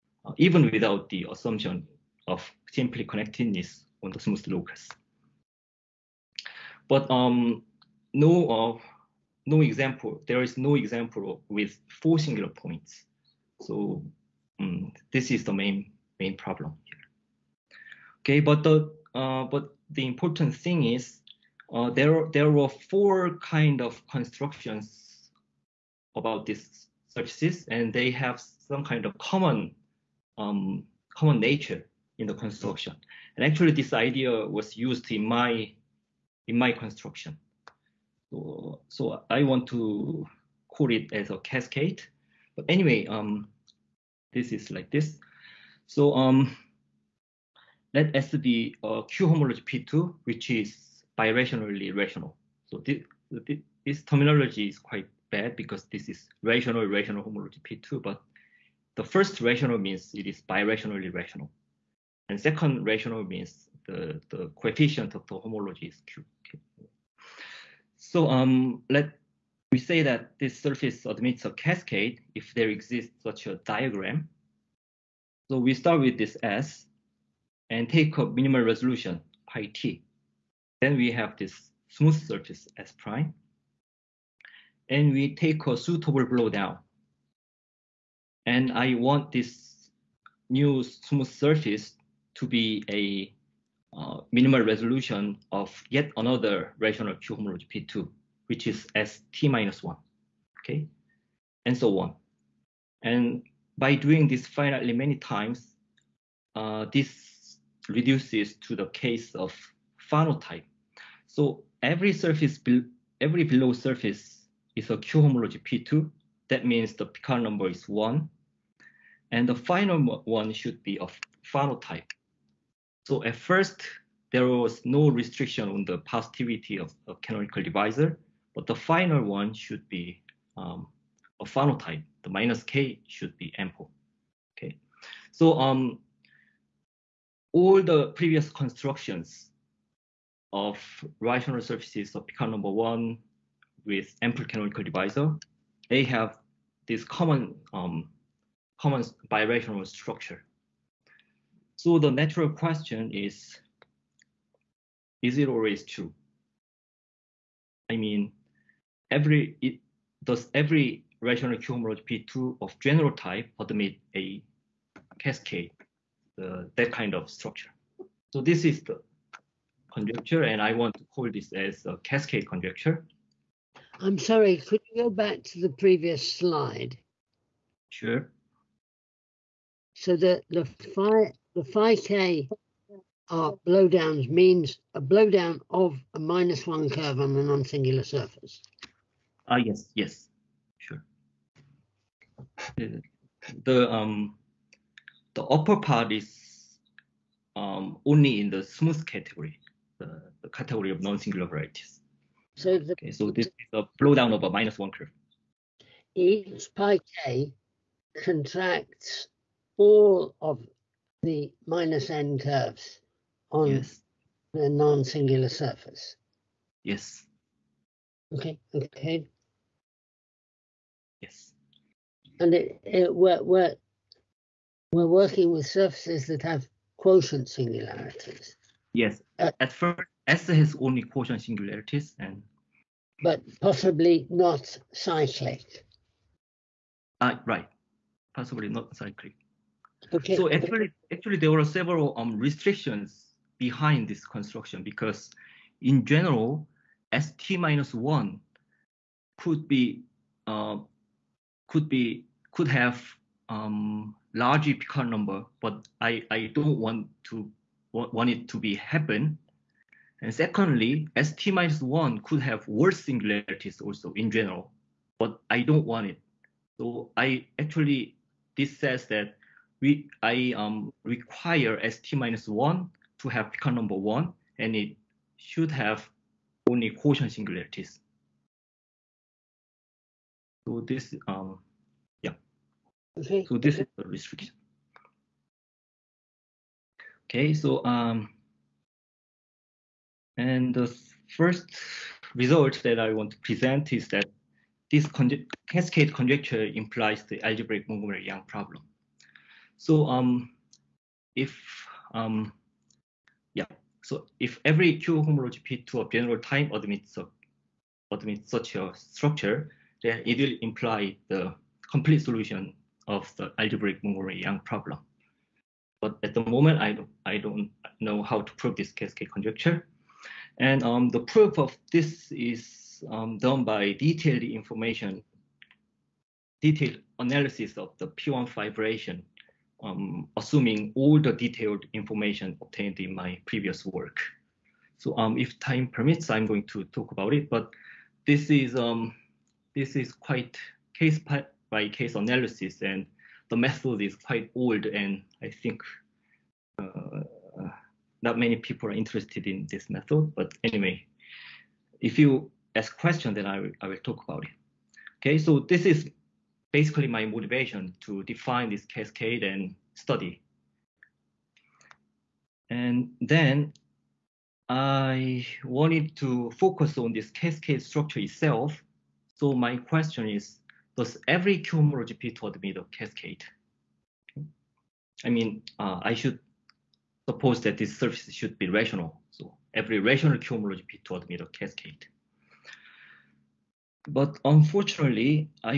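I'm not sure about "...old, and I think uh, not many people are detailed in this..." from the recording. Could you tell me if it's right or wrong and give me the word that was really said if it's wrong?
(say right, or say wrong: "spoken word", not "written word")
wrong: "interested", not "detailed".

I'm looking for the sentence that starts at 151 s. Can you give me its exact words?
So the natural question is, is it always true?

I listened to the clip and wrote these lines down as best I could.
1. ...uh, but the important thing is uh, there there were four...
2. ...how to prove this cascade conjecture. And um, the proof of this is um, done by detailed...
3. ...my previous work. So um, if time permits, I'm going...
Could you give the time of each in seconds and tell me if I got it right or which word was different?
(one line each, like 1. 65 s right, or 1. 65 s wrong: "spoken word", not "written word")
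1. 19 s right
2. 318 s right
3. 333 s right.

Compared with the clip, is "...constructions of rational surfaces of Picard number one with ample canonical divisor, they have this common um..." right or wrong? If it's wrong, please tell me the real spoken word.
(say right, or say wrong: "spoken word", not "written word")
right.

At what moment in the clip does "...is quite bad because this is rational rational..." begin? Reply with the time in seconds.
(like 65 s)
54 s.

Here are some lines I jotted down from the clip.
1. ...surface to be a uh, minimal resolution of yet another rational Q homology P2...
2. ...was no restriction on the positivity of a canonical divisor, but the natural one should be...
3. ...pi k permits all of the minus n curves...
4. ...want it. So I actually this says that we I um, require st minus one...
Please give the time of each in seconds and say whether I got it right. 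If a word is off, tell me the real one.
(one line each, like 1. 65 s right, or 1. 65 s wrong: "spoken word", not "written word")
1. 91 s right
2. 124 s wrong: "final", not "natural"
3. 206 s wrong: "contracts", not "permits"
4. 265 s right.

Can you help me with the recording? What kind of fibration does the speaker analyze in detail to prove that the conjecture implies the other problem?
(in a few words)
P1 fibration.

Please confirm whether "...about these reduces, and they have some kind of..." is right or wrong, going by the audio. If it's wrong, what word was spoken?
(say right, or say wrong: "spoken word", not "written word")
wrong: "surfaces", not "reduces".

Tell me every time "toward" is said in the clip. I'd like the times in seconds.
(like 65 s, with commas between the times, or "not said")
372 s, 381 s.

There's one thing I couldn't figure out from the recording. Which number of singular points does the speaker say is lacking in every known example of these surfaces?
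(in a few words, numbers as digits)
4.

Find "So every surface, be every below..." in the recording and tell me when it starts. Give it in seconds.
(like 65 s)
111 s.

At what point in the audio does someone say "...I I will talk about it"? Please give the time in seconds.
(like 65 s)
353 s.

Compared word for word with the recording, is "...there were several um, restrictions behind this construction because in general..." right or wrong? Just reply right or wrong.
right.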